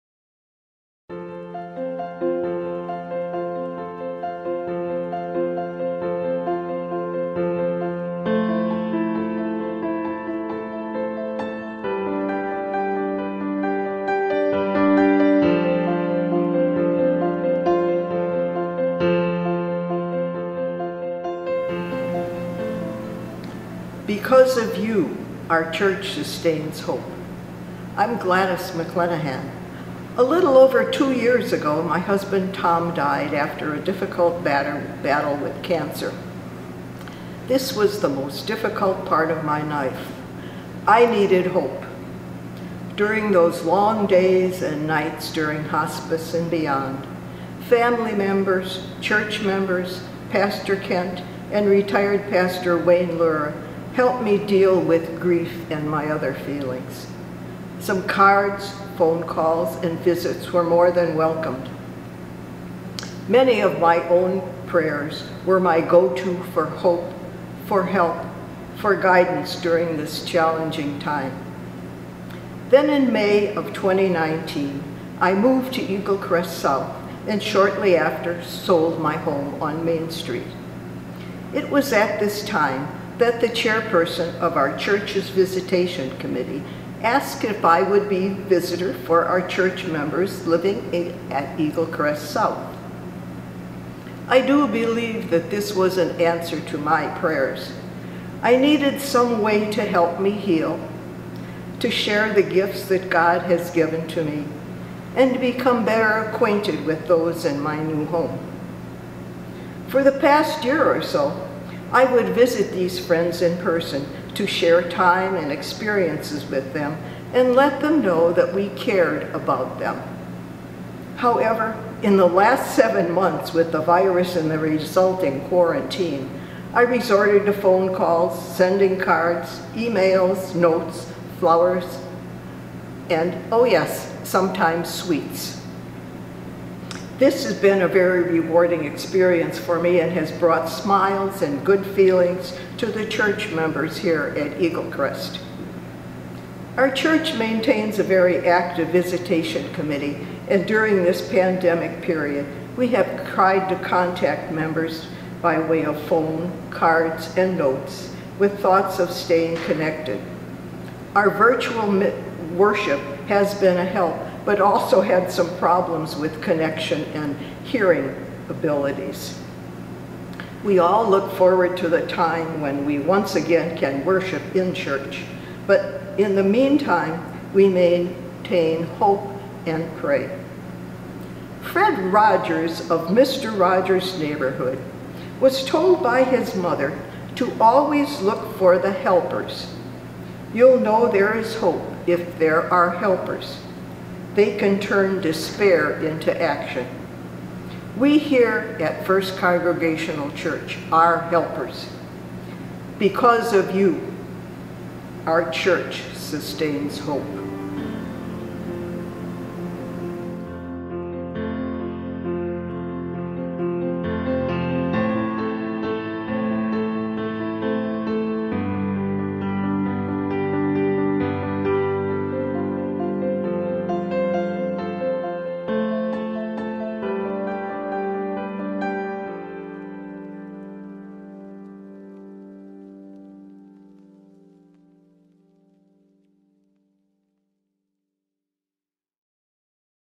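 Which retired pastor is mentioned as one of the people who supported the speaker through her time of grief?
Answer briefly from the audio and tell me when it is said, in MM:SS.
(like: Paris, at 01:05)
Wayne Lura, at 00:52.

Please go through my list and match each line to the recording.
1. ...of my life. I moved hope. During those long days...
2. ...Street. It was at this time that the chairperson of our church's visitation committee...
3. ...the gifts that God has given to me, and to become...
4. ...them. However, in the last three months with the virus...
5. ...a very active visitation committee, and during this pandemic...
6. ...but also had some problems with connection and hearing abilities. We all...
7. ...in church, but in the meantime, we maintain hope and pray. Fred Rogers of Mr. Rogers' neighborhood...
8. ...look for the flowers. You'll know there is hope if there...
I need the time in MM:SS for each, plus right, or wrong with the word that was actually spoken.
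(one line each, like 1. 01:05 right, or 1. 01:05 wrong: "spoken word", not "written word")
1. 00:39 wrong: "needed", not "moved"
2. 01:20 right
3. 01:42 right
4. 01:59 wrong: "seven", not "three"
5. 02:27 right
6. 02:44 right
7. 02:54 right
8. 03:08 wrong: "helpers", not "flowers".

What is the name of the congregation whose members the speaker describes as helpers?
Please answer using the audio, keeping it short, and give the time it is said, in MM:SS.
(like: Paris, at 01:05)
First Congregational Church, at 03:19.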